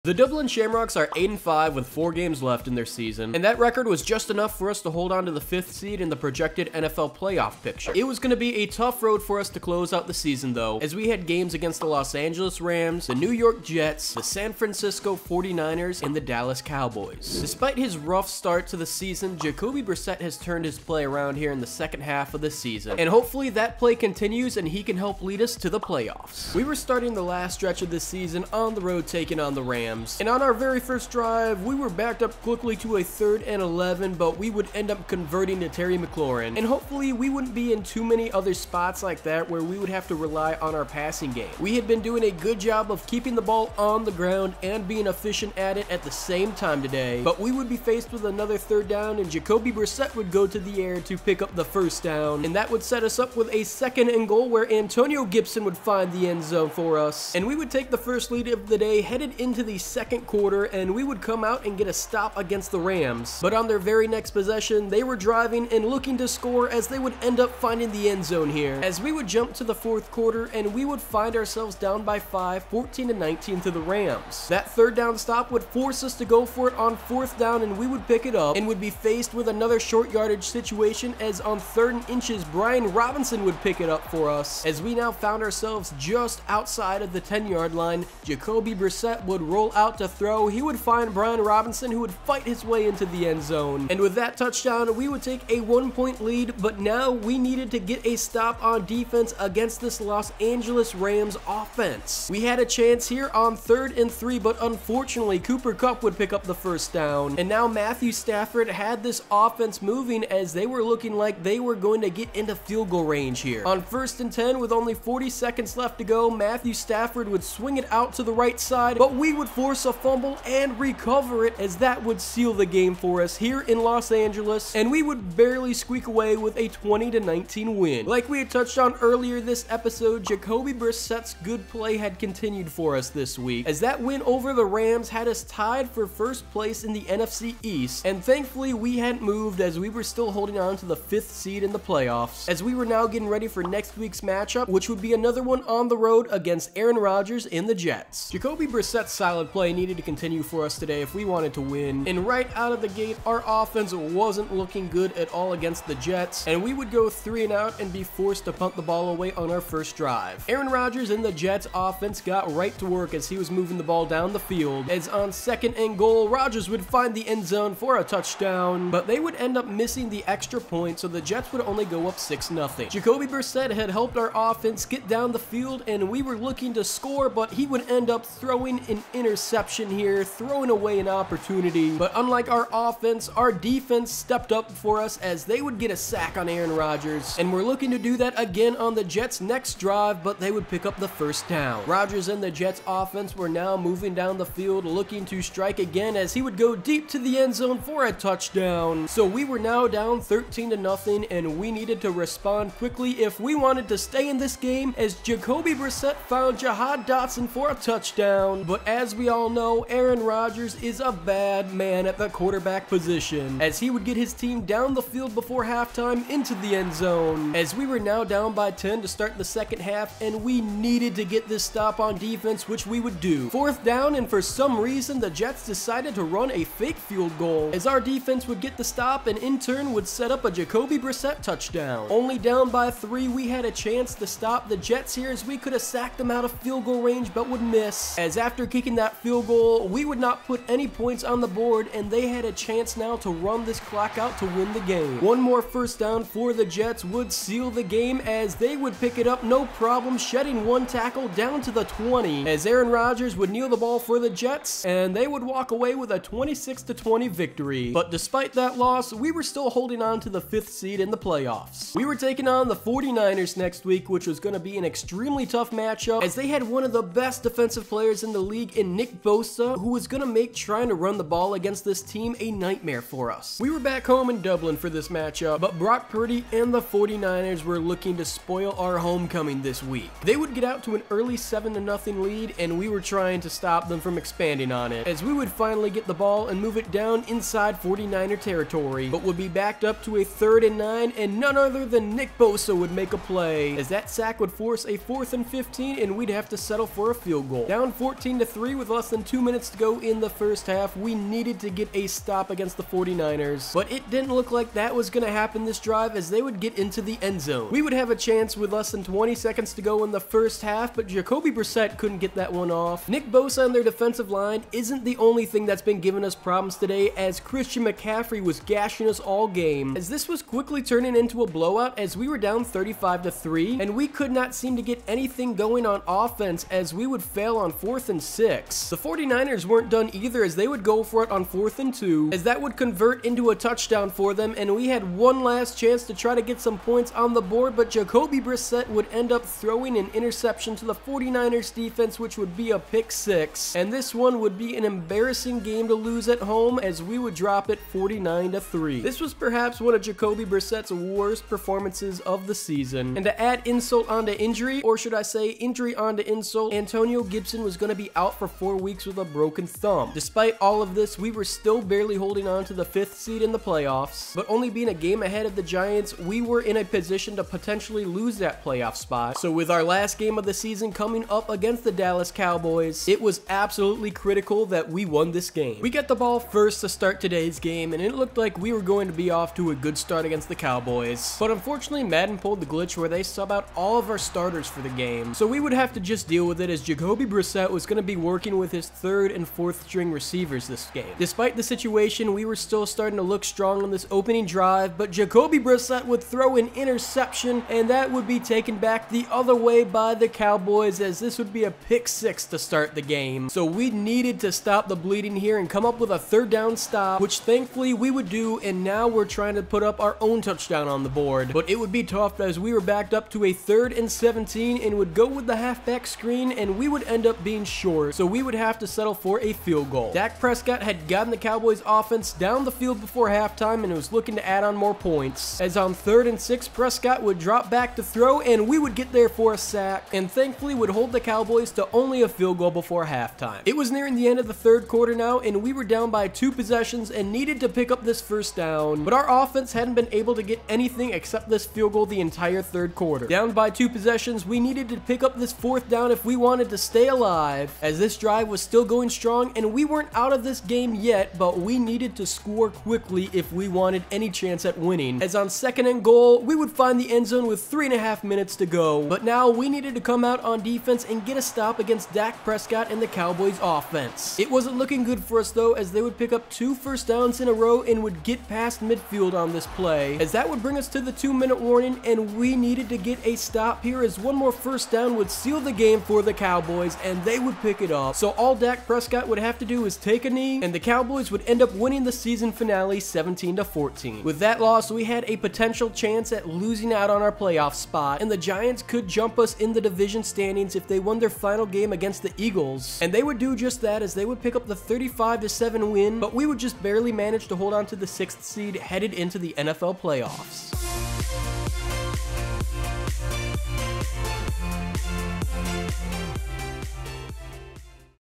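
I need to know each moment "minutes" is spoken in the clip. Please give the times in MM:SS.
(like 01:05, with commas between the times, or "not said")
04:59, 07:38, 07:51.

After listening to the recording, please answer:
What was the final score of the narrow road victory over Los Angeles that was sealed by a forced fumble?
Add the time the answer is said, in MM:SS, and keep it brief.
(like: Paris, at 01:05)
20-19, at 02:06.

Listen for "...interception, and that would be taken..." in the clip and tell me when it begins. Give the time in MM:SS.
06:36.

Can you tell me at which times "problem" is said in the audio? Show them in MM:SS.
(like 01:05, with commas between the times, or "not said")
04:09, 05:16.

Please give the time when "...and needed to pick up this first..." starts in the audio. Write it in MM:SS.
07:17.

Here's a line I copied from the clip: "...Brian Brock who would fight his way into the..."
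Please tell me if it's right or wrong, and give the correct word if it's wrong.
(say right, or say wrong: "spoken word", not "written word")
wrong: "Robinson", not "Brock".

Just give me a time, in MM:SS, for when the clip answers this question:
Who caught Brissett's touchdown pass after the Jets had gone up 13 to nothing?
03:26.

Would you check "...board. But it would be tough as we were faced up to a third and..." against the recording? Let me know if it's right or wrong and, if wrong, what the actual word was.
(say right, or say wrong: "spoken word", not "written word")
wrong: "backed", not "faced".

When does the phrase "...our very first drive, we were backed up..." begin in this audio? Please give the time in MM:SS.
00:30.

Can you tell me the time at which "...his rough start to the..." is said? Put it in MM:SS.
00:17.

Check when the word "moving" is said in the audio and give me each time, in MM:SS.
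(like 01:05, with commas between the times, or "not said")
01:49, 02:43, 03:13.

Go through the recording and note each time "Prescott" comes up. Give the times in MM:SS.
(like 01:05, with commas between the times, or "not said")
07:00, 07:06, 07:42, 07:58.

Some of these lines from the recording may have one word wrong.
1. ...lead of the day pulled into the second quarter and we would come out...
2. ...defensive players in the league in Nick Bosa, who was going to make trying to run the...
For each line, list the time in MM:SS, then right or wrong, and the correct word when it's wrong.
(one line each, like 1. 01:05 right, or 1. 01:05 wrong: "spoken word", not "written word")
1. 00:58 wrong: "headed", not "pulled"
2. 04:27 right.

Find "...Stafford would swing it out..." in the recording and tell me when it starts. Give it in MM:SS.
01:56.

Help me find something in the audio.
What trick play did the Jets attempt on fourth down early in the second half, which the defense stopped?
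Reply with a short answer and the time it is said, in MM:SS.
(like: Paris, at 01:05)
Fake field goal, at 03:46.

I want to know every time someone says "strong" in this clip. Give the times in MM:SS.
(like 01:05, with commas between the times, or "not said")
06:33, 07:29.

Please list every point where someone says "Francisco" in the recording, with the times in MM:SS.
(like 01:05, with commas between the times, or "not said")
00:14.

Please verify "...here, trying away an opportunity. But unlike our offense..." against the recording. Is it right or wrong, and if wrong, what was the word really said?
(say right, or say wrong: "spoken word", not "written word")
wrong: "throwing", not "trying".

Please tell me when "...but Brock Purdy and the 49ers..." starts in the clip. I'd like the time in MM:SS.
04:35.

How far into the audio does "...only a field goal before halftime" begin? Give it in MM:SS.
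07:11.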